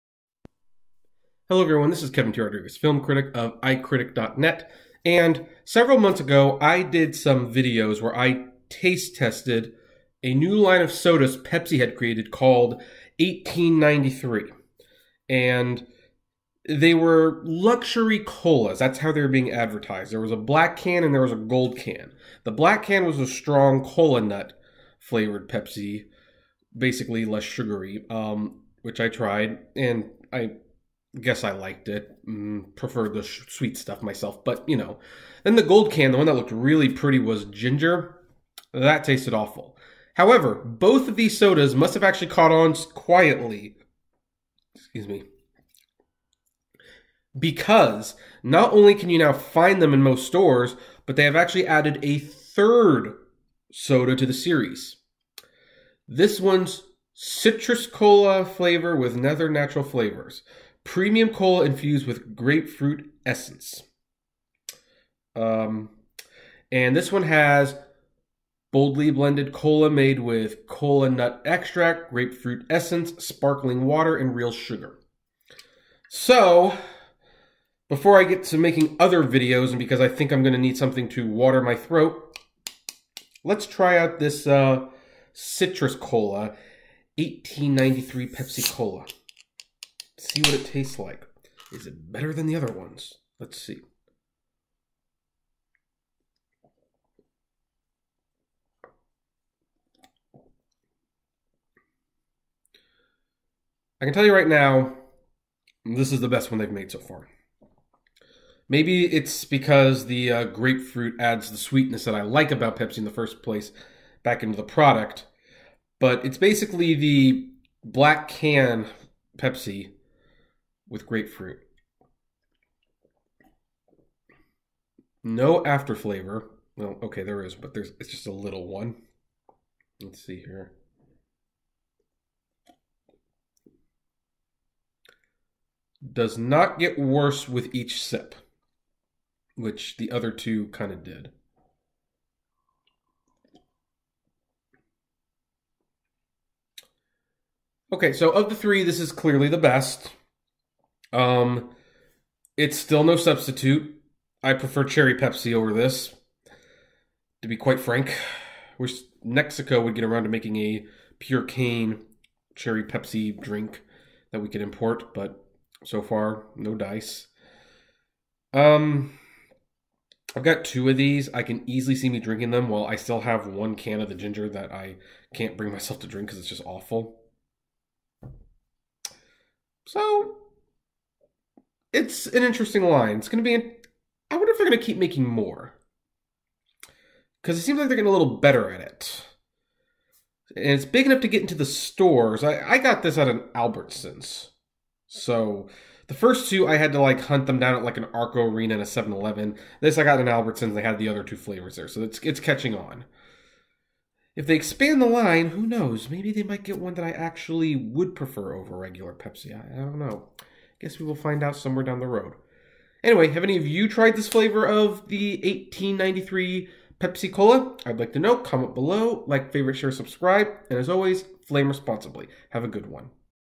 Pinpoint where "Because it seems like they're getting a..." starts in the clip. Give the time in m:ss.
3:07.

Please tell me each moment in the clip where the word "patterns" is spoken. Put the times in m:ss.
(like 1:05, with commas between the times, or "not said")
not said.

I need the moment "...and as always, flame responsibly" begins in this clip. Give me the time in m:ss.
3:40.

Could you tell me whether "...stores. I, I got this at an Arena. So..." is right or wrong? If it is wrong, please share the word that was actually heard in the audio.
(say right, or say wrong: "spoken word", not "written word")
wrong: "Albertsons", not "Arena".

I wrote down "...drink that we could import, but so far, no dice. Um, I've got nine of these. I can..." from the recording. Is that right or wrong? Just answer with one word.
wrong.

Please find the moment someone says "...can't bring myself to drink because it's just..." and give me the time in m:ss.
2:55.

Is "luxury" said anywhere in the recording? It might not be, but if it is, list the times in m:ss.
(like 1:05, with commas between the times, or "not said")
0:17.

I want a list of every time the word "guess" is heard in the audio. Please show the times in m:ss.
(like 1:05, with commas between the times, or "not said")
0:31, 3:30.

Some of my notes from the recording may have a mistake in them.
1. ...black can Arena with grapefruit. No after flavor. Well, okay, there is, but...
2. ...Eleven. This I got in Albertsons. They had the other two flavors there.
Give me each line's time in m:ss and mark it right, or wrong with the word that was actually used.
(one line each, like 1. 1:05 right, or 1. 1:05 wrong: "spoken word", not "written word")
1. 1:57 wrong: "Pepsi", not "Arena"
2. 3:19 right.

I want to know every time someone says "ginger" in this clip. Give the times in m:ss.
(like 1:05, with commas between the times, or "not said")
0:37, 2:54.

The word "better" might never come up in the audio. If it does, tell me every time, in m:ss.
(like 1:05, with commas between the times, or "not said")
1:32, 3:08.